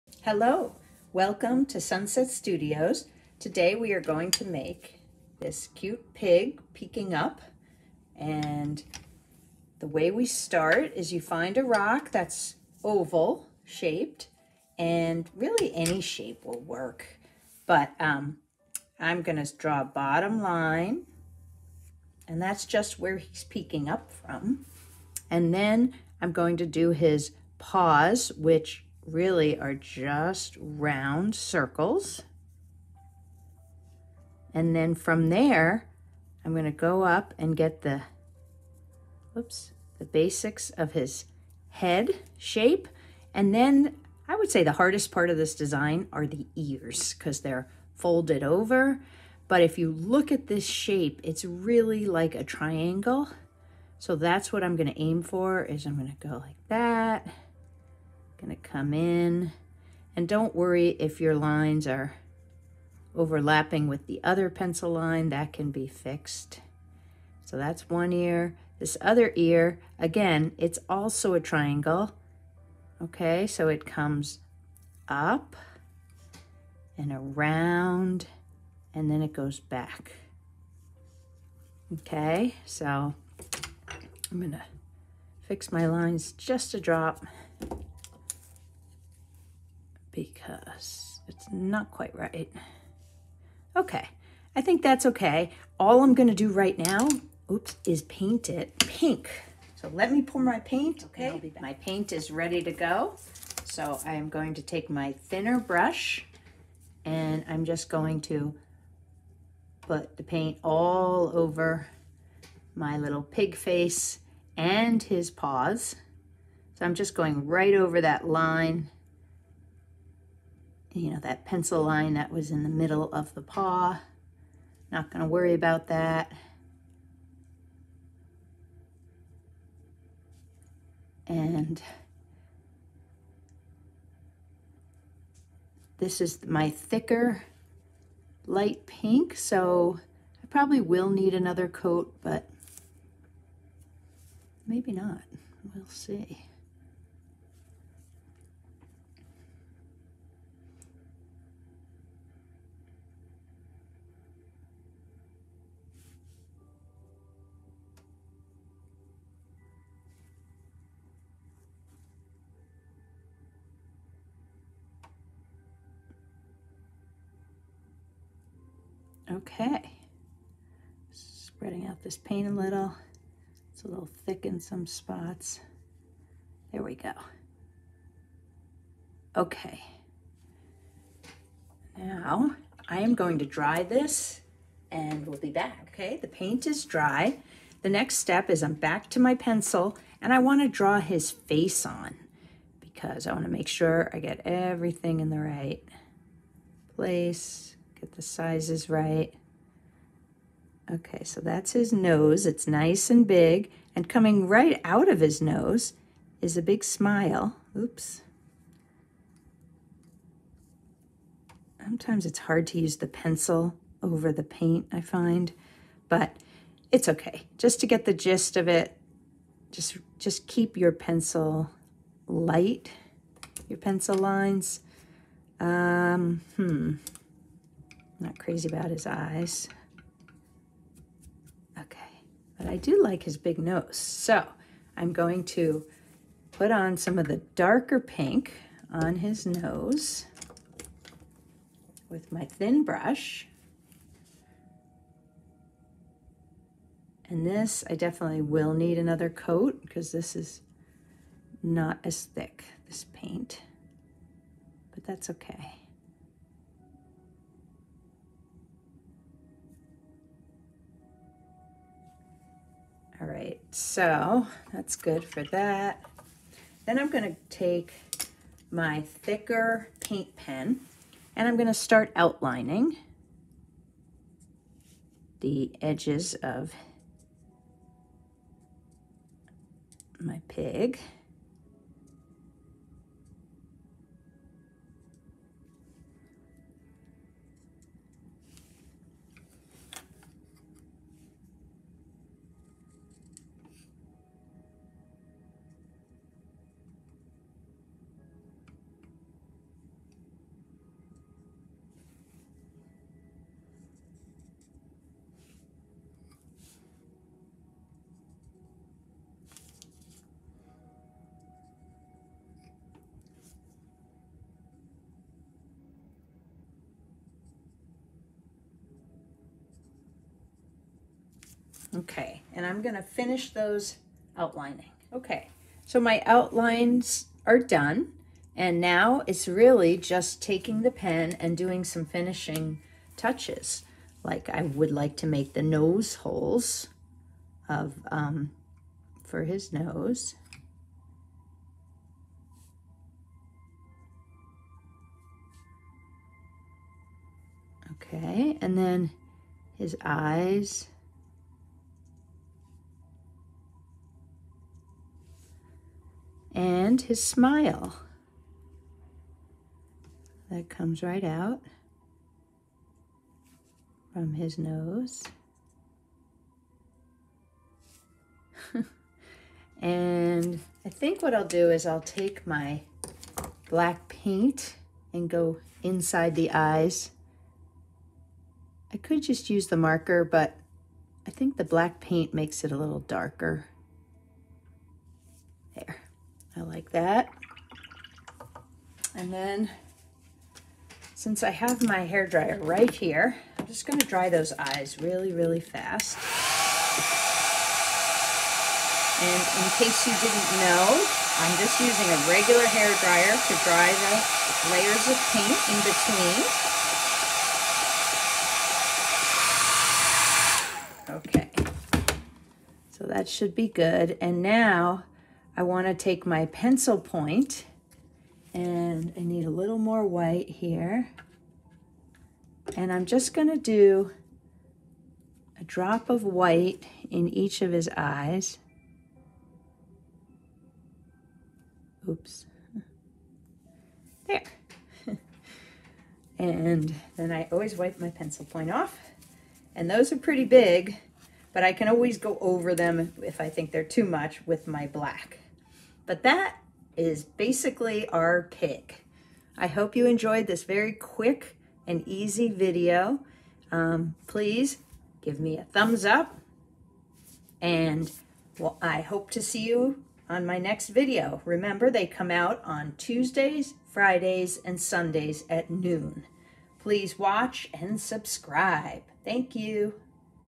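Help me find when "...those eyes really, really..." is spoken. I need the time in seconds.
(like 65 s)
394 s.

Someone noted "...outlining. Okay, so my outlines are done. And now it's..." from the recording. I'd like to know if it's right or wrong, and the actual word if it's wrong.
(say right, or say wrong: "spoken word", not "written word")
right.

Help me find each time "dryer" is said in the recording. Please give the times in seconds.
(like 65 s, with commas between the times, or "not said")
392 s, 403 s.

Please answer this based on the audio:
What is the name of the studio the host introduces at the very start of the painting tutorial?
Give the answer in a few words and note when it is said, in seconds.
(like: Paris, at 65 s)
Sunset Studios, at 1 s.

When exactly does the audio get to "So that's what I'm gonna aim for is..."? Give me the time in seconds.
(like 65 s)
53 s.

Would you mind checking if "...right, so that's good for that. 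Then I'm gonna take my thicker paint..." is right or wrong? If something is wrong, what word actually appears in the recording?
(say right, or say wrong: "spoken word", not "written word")
right.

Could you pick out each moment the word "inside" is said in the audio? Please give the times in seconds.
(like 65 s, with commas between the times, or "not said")
375 s.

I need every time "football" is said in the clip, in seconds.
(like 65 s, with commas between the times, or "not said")
not said.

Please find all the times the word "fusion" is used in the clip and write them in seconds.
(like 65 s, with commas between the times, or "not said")
not said.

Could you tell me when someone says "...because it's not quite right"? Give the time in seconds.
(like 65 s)
90 s.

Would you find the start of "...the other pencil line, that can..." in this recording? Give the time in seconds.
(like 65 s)
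64 s.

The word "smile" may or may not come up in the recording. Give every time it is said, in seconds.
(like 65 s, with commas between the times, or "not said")
206 s, 357 s.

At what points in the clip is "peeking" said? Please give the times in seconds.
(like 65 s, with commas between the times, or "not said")
6 s, 23 s.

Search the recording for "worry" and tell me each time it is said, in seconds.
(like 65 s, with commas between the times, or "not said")
60 s, 125 s.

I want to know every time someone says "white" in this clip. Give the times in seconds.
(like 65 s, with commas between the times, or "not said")
420 s, 426 s.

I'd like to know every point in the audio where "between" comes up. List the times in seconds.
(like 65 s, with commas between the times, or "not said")
405 s.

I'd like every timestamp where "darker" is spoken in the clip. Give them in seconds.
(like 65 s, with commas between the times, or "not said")
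237 s, 382 s.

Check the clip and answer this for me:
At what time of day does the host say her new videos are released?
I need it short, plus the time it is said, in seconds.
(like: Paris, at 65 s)
noon, at 465 s.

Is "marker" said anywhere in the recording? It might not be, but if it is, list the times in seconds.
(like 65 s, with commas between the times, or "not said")
379 s.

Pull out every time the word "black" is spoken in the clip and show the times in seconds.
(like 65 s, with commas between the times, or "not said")
373 s, 381 s, 444 s.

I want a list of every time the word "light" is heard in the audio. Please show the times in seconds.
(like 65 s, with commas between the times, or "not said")
138 s, 222 s.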